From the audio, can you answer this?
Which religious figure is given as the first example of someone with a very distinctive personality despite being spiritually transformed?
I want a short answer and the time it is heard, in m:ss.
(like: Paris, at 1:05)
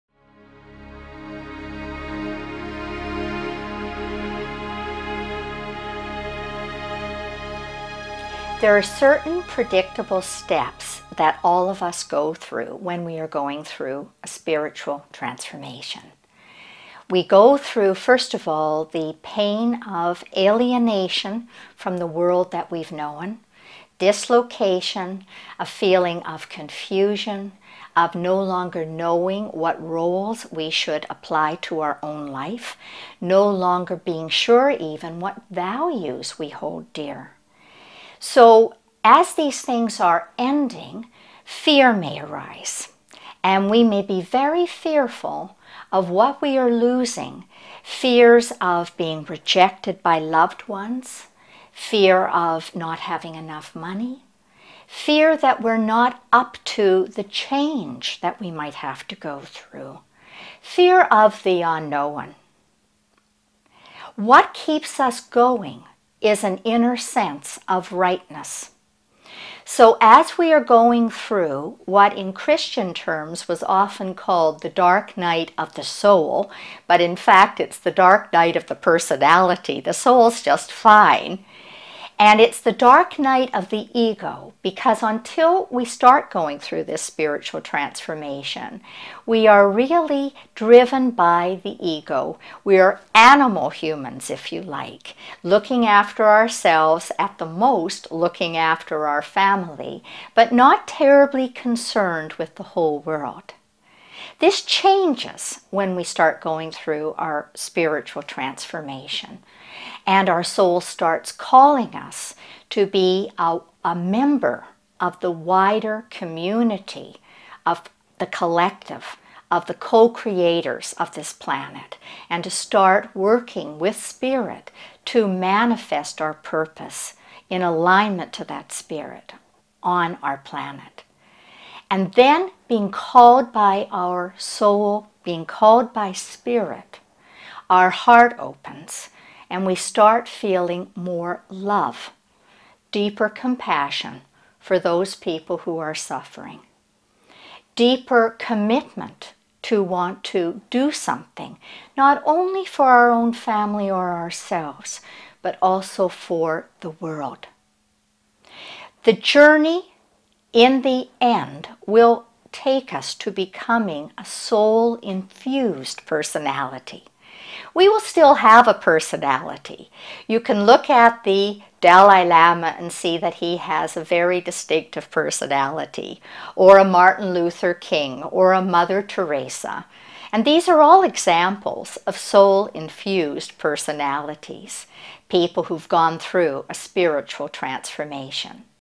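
The Dalai Lama, at 2:51.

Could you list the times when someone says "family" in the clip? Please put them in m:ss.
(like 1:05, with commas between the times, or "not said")
1:39, 2:33.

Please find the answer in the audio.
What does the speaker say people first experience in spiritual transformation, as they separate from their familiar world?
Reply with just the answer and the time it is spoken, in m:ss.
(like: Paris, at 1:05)
Alienation, at 0:20.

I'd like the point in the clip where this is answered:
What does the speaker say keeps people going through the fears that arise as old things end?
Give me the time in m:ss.
1:06.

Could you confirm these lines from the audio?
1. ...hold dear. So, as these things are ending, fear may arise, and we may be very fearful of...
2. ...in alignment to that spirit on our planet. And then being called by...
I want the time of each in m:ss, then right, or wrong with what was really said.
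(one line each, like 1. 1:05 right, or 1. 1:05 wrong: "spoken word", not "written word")
1. 0:36 right
2. 2:07 right.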